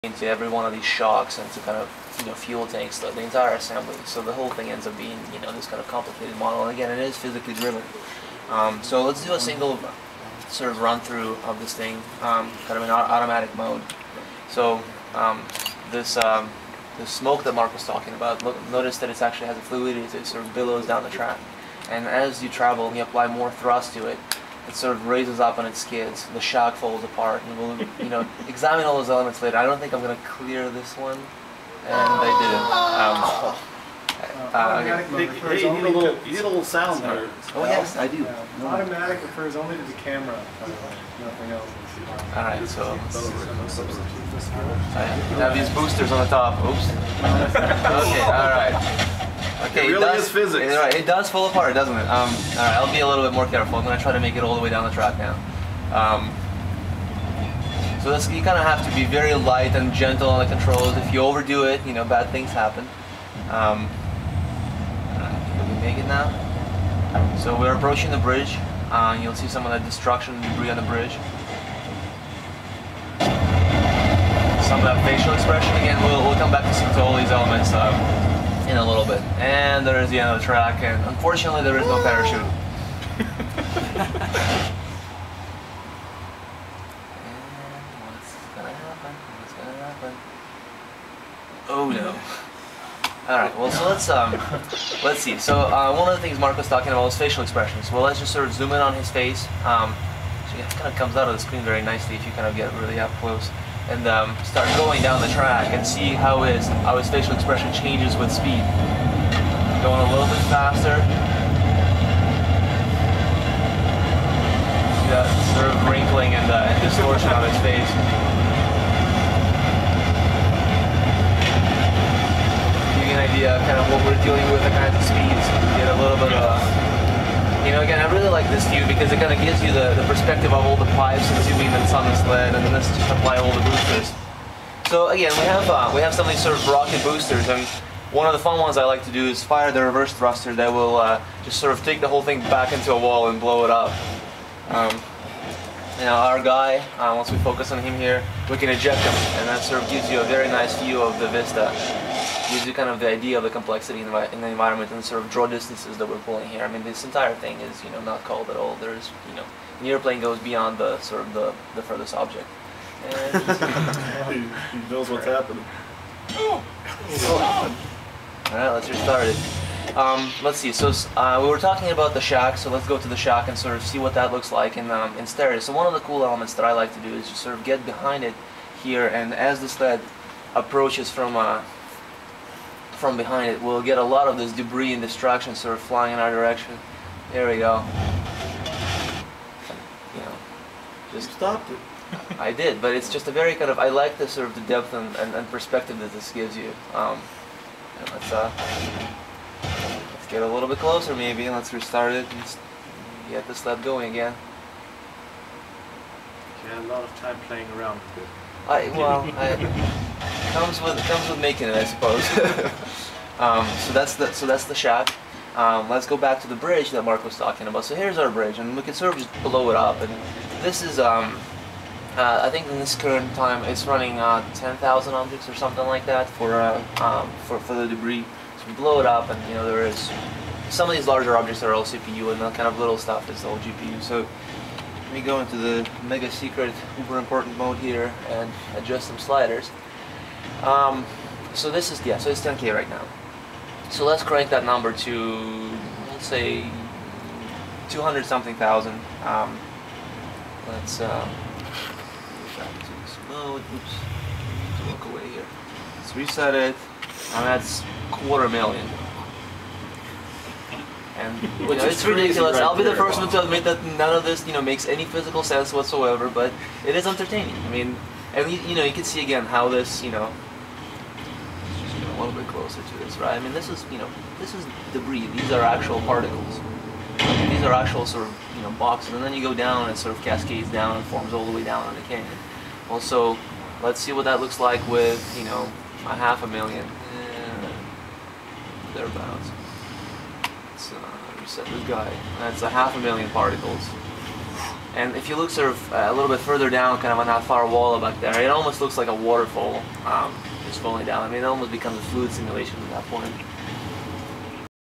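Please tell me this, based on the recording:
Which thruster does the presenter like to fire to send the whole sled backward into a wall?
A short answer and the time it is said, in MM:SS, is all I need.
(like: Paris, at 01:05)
Reverse thruster, at 02:19.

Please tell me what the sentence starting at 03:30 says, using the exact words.
Comes with comes with making it, I suppose.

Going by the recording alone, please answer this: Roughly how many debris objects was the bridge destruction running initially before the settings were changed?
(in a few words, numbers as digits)
10,000.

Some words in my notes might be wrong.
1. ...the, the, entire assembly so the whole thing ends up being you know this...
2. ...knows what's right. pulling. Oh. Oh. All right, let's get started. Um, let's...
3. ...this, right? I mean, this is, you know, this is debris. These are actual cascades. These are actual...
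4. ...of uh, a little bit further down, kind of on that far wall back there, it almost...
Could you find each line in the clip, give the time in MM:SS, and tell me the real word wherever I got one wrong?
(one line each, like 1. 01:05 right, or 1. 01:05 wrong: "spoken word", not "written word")
1. 00:02 right
2. 02:44 wrong: "happening", not "pulling"
3. 04:33 wrong: "particles", not "cascades"
4. 04:55 right.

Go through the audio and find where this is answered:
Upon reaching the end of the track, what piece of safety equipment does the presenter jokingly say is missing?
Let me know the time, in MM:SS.
01:22.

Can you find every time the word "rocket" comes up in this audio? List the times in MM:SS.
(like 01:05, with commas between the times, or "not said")
02:16.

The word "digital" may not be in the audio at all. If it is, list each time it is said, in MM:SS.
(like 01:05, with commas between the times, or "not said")
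not said.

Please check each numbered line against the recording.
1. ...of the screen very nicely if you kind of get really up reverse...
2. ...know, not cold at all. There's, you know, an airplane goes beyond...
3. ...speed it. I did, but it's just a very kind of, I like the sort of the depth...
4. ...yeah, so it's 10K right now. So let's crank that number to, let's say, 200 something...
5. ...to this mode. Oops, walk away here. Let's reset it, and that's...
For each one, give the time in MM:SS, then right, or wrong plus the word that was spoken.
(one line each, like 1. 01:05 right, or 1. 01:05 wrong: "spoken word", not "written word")
1. 01:41 wrong: "close", not "reverse"
2. 02:37 right
3. 03:11 wrong: "stopped", not "speed"
4. 04:02 right
5. 04:12 right.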